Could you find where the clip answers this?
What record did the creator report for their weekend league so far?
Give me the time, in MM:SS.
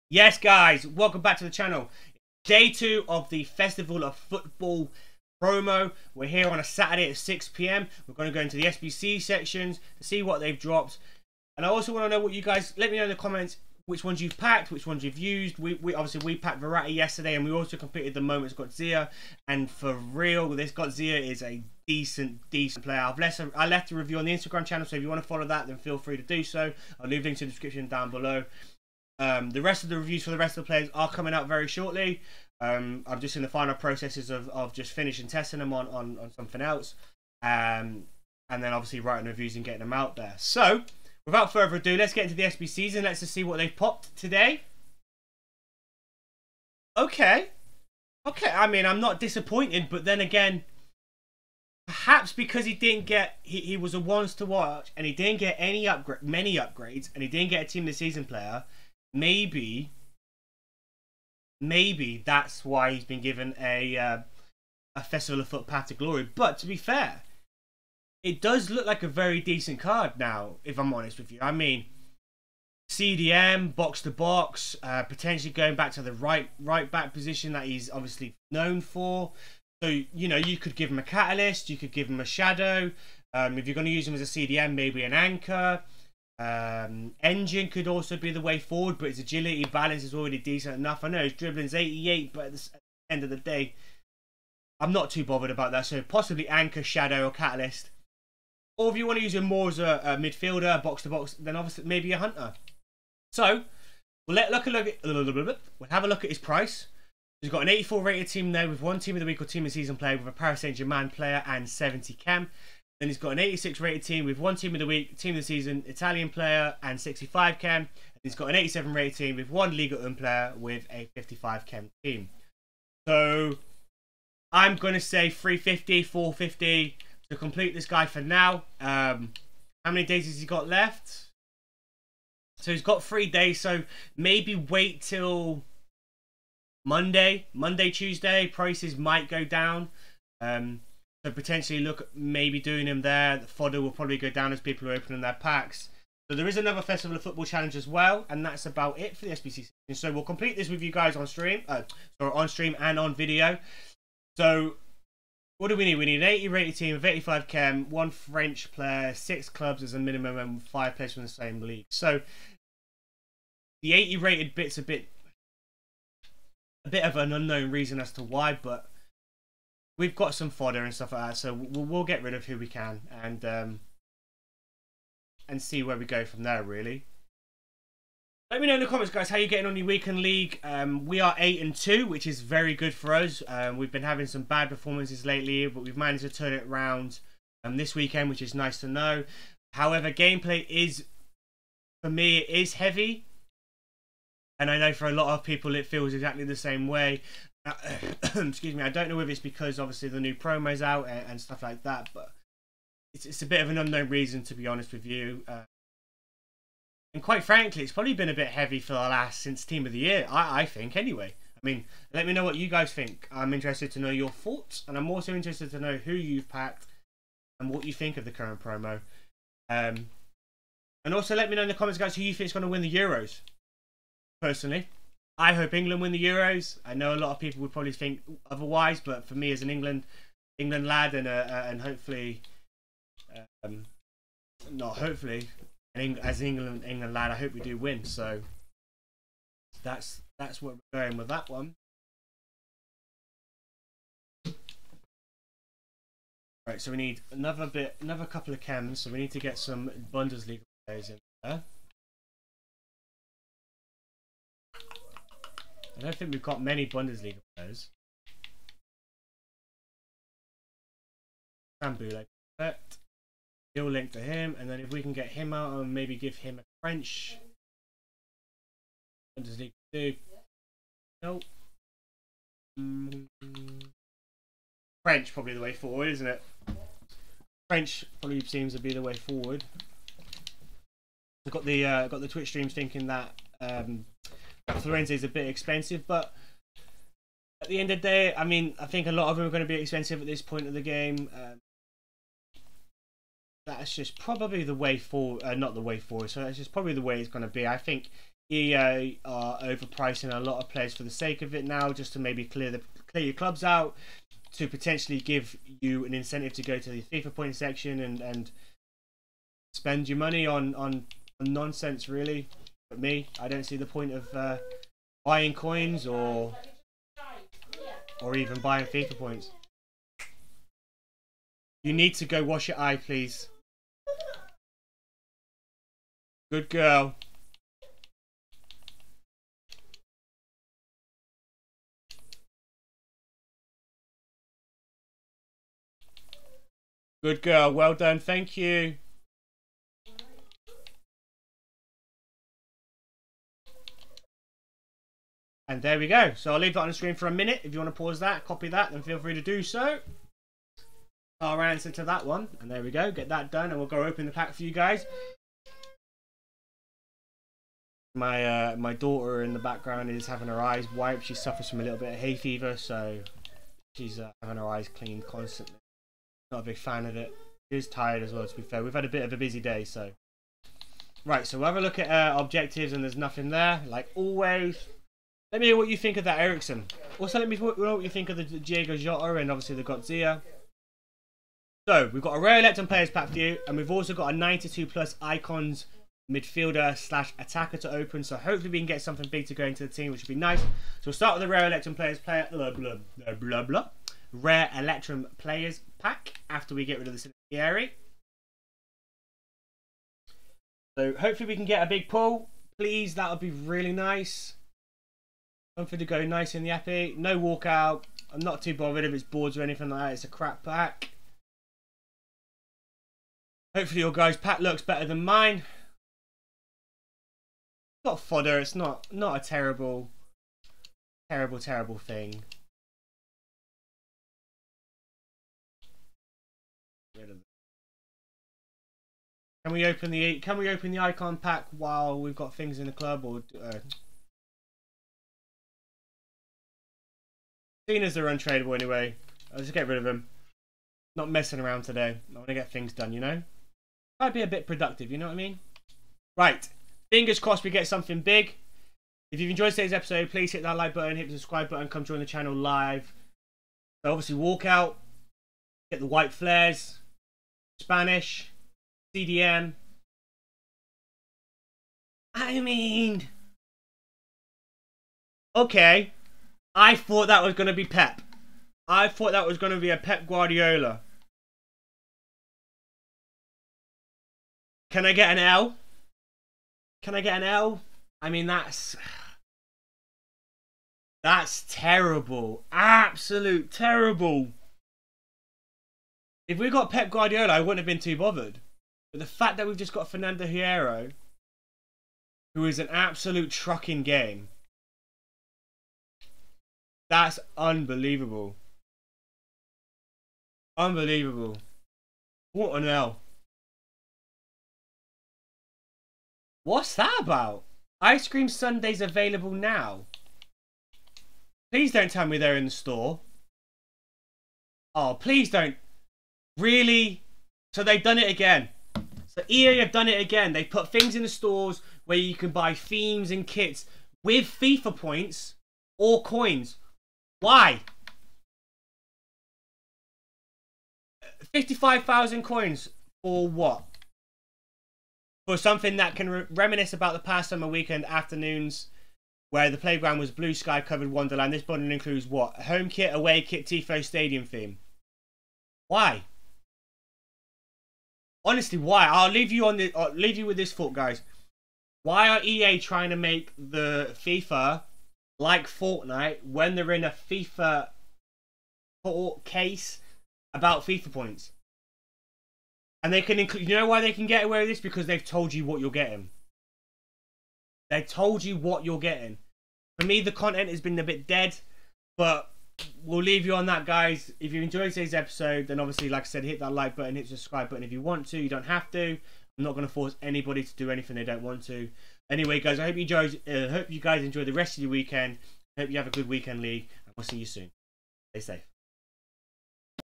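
03:01.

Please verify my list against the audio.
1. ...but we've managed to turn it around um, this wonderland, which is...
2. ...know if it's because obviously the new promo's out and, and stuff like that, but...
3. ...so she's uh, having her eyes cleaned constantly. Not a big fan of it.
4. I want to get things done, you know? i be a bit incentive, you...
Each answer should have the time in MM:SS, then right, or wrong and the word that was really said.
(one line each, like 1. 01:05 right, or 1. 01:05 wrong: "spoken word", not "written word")
1. 03:05 wrong: "weekend", not "wonderland"
2. 03:19 right
3. 06:02 right
4. 07:22 wrong: "productive", not "incentive".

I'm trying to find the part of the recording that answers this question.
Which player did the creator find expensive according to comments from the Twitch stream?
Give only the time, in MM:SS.
04:44.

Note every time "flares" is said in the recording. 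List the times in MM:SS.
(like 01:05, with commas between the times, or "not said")
07:36.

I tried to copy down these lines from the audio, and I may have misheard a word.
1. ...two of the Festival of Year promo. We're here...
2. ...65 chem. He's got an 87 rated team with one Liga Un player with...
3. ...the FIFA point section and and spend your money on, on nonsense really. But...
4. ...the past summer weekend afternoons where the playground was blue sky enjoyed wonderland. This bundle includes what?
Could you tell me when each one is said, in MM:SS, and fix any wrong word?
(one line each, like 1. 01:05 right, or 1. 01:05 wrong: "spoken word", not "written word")
1. 00:02 wrong: "Football", not "Year"
2. 01:57 right
3. 05:06 right
4. 08:57 wrong: "covered", not "enjoyed".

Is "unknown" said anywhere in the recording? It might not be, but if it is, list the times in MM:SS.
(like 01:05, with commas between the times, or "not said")
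02:47, 03:23.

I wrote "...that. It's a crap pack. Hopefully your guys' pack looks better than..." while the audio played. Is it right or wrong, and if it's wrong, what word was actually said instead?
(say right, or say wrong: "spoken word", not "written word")
right.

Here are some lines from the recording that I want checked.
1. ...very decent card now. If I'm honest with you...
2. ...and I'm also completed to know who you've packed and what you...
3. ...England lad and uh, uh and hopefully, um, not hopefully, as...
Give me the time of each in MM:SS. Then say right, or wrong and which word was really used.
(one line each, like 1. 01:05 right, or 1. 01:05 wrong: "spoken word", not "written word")
1. 01:09 right
2. 03:34 wrong: "interested", not "completed"
3. 03:50 right.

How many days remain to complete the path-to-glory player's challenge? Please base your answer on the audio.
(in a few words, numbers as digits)
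3.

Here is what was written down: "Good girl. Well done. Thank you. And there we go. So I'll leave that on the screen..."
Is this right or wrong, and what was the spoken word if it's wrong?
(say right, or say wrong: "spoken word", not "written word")
right.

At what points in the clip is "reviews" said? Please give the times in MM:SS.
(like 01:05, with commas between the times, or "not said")
00:23, 00:29, 00:39.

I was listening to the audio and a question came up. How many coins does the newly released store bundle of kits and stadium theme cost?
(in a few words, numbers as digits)
55,000.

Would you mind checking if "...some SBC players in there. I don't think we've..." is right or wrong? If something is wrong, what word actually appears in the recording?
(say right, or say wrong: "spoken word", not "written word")
wrong: "Bundesliga", not "SBC".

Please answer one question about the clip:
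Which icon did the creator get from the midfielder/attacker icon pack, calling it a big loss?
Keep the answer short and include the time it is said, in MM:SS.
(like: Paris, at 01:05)
Fernando Hierro, at 08:10.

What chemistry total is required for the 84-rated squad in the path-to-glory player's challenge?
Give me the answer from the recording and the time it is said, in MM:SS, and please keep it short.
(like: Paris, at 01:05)
70, at 01:51.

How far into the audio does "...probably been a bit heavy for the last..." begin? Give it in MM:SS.
03:27.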